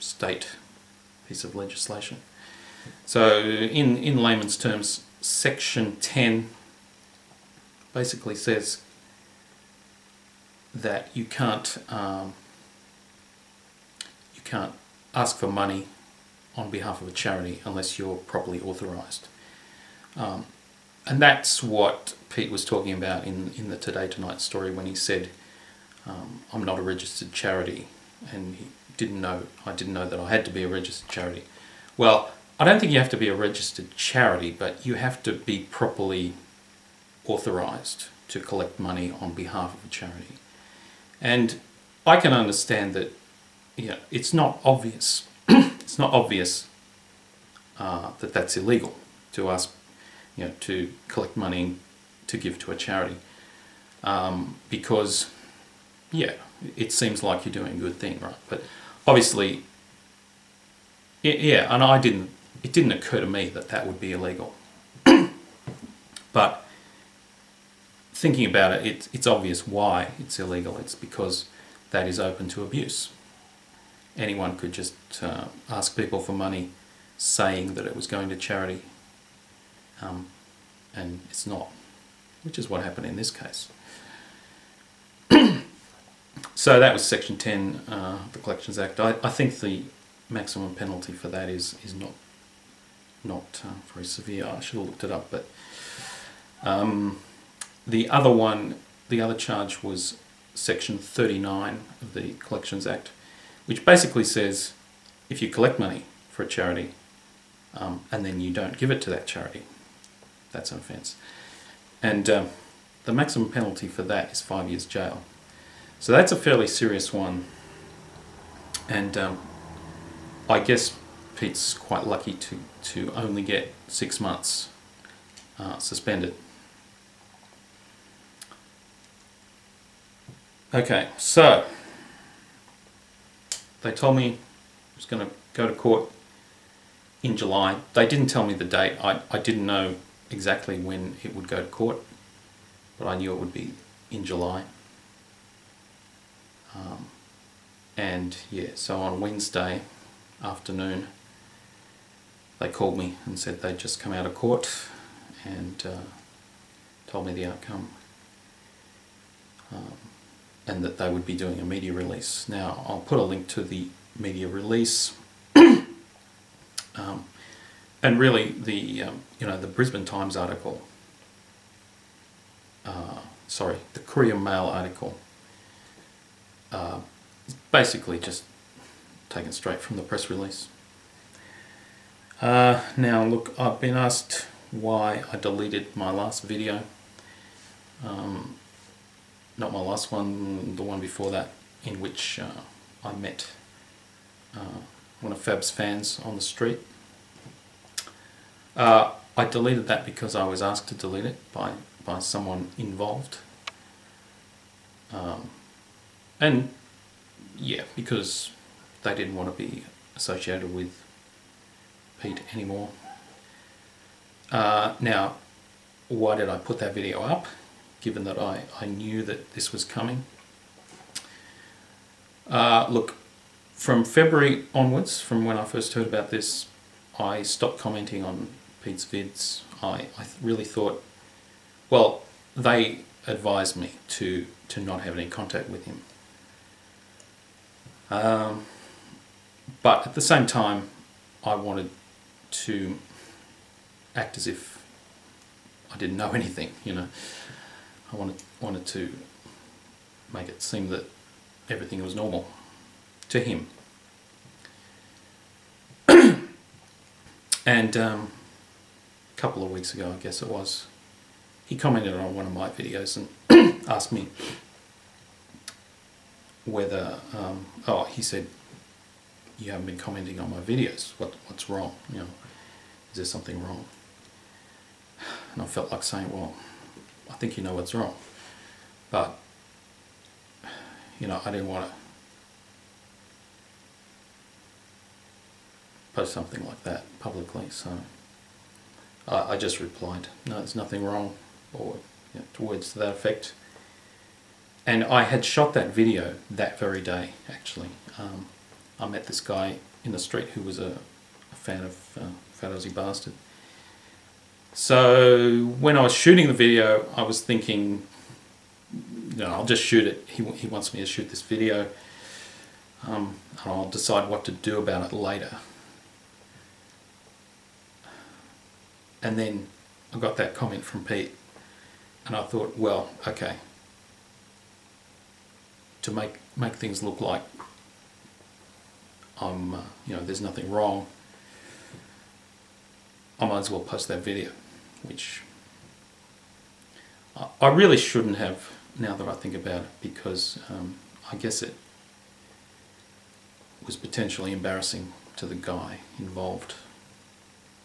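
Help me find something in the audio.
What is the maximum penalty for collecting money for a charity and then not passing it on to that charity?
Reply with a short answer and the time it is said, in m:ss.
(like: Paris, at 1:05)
5 years jail, at 1:54.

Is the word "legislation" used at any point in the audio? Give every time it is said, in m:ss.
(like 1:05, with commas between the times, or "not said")
0:01.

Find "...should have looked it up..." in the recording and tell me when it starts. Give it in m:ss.
1:34.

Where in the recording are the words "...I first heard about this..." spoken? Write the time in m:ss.
3:45.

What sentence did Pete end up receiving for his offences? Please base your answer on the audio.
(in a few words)
6 months suspended.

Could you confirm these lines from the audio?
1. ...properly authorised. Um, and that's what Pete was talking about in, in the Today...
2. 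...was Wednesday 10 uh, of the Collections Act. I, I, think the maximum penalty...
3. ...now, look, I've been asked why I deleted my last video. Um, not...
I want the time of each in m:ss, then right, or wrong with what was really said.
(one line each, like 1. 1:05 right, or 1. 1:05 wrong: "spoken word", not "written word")
1. 0:18 right
2. 1:26 wrong: "Section", not "Wednesday"
3. 3:02 right.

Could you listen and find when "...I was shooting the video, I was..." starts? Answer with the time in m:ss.
5:05.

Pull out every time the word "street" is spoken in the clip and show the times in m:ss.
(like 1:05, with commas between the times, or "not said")
3:16, 5:00.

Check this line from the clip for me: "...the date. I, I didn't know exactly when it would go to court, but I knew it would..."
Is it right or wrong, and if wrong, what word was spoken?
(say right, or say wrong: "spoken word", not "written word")
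right.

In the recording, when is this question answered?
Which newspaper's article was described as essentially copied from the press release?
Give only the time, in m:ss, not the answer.
2:53.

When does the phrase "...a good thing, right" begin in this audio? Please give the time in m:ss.
0:57.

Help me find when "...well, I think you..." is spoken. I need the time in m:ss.
4:36.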